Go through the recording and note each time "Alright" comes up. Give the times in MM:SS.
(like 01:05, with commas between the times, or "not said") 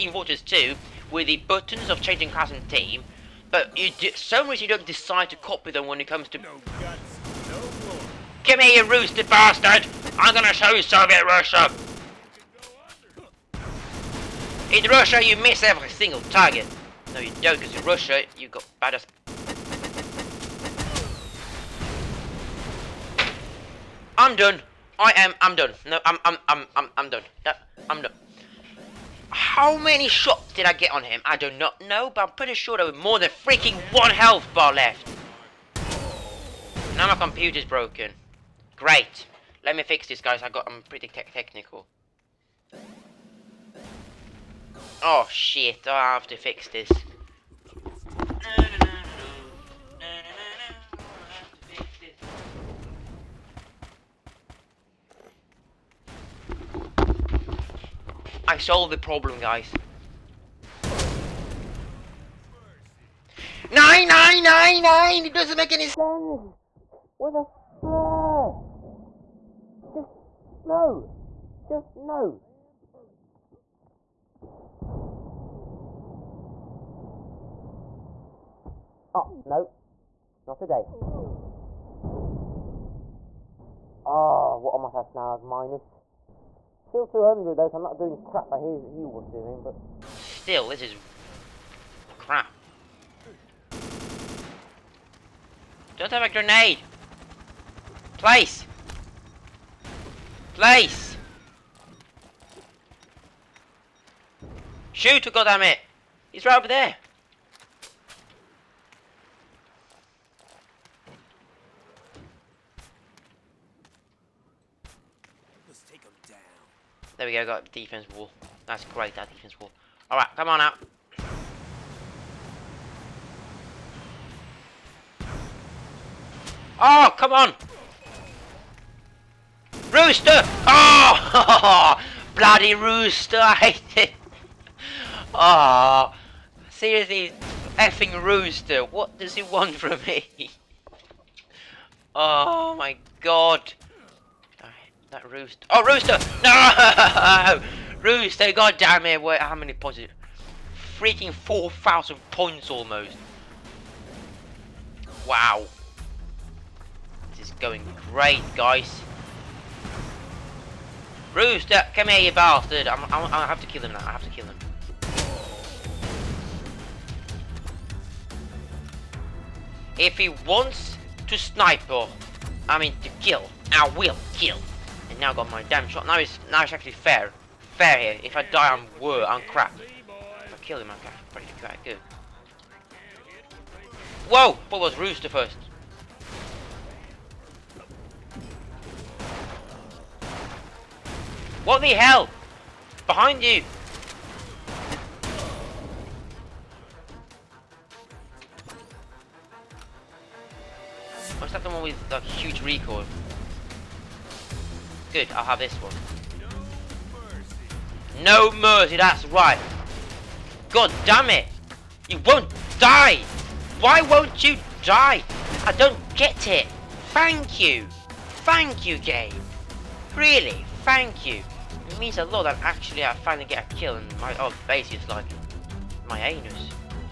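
02:00.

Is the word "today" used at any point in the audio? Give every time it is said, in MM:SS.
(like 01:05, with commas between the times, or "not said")
01:20.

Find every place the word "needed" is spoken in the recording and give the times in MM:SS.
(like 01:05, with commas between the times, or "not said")
not said.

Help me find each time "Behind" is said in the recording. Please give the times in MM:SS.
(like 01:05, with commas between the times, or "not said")
03:13.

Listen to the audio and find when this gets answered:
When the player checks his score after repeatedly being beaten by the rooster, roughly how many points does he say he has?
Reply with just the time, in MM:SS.
02:31.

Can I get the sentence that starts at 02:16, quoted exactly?
Seriously, effing rooster, what does he want from me?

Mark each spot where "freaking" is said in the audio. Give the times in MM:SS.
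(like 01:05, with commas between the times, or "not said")
00:33, 02:30.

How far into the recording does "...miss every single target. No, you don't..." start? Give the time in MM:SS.
00:15.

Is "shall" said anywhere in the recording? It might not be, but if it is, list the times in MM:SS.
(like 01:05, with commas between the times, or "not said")
not said.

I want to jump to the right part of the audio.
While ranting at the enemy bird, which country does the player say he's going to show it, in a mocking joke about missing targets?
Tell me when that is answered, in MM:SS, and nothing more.
00:10.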